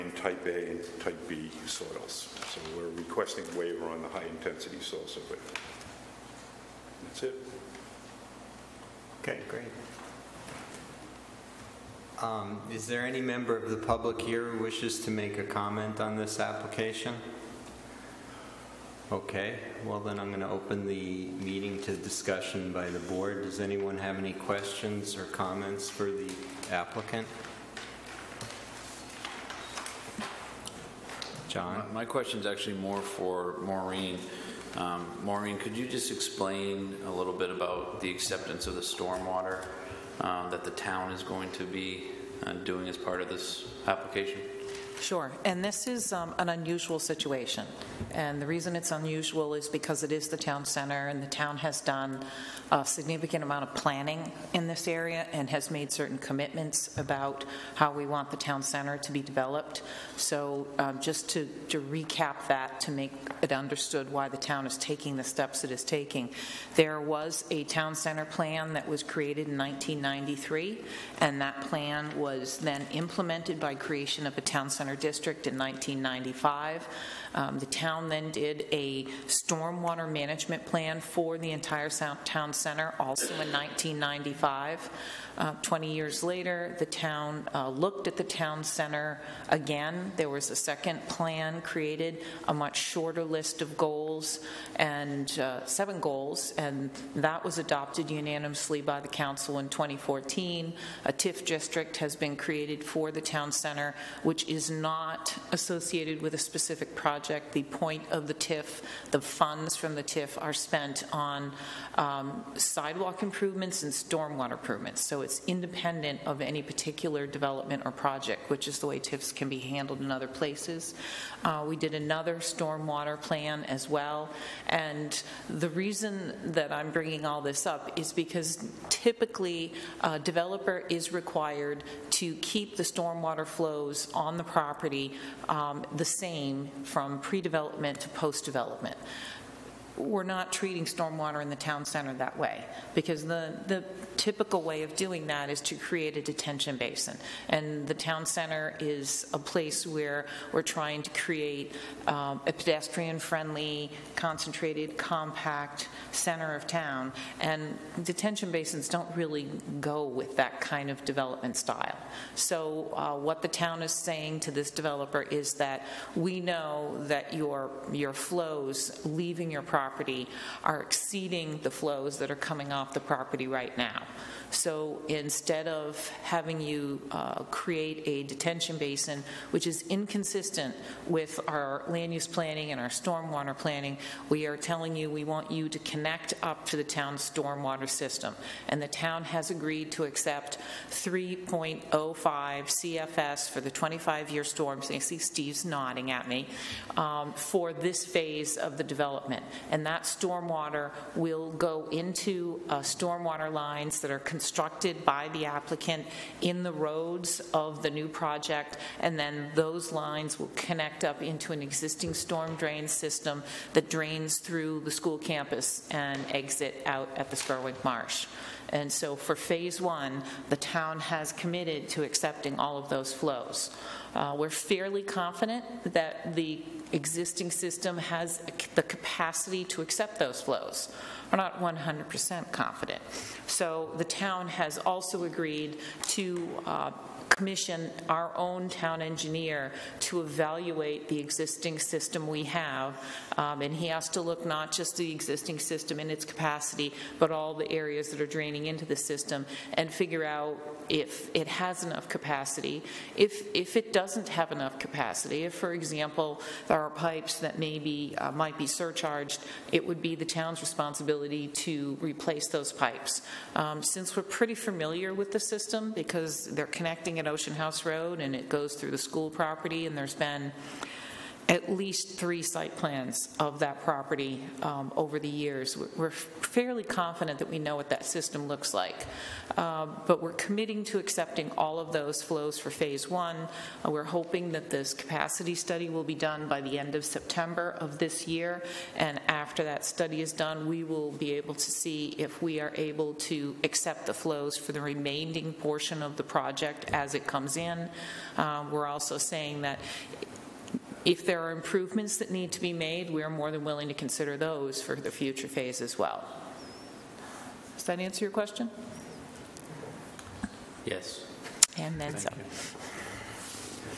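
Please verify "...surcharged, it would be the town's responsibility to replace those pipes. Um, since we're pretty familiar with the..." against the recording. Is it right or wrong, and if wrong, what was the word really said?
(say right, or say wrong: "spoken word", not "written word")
right.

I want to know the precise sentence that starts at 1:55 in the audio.
So it's independent of any particular development or project, which is the way TIFs can be handled in other places.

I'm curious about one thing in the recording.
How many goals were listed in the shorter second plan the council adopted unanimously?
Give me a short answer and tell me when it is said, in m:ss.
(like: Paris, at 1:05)
7, at 1:35.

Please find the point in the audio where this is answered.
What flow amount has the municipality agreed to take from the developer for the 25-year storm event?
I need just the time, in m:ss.
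3:10.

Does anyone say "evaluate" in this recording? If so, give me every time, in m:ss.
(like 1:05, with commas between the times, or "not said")
4:00.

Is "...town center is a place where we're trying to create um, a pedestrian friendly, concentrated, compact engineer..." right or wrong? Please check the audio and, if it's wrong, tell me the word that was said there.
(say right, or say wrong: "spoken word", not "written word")
wrong: "center", not "engineer".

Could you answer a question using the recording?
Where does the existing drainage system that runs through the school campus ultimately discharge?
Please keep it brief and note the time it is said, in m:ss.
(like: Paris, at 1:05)
Spurwink Marsh, at 3:37.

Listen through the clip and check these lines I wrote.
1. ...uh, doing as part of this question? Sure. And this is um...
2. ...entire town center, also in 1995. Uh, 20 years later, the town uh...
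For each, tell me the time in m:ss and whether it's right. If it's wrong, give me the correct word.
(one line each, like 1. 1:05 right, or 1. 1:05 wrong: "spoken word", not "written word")
1. 0:42 wrong: "application", not "question"
2. 1:21 right.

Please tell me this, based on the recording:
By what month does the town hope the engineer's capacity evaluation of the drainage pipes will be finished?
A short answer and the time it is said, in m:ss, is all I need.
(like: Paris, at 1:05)
September, at 4:47.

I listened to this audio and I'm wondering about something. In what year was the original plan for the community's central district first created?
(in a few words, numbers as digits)
1993.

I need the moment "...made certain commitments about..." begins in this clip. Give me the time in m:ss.
0:55.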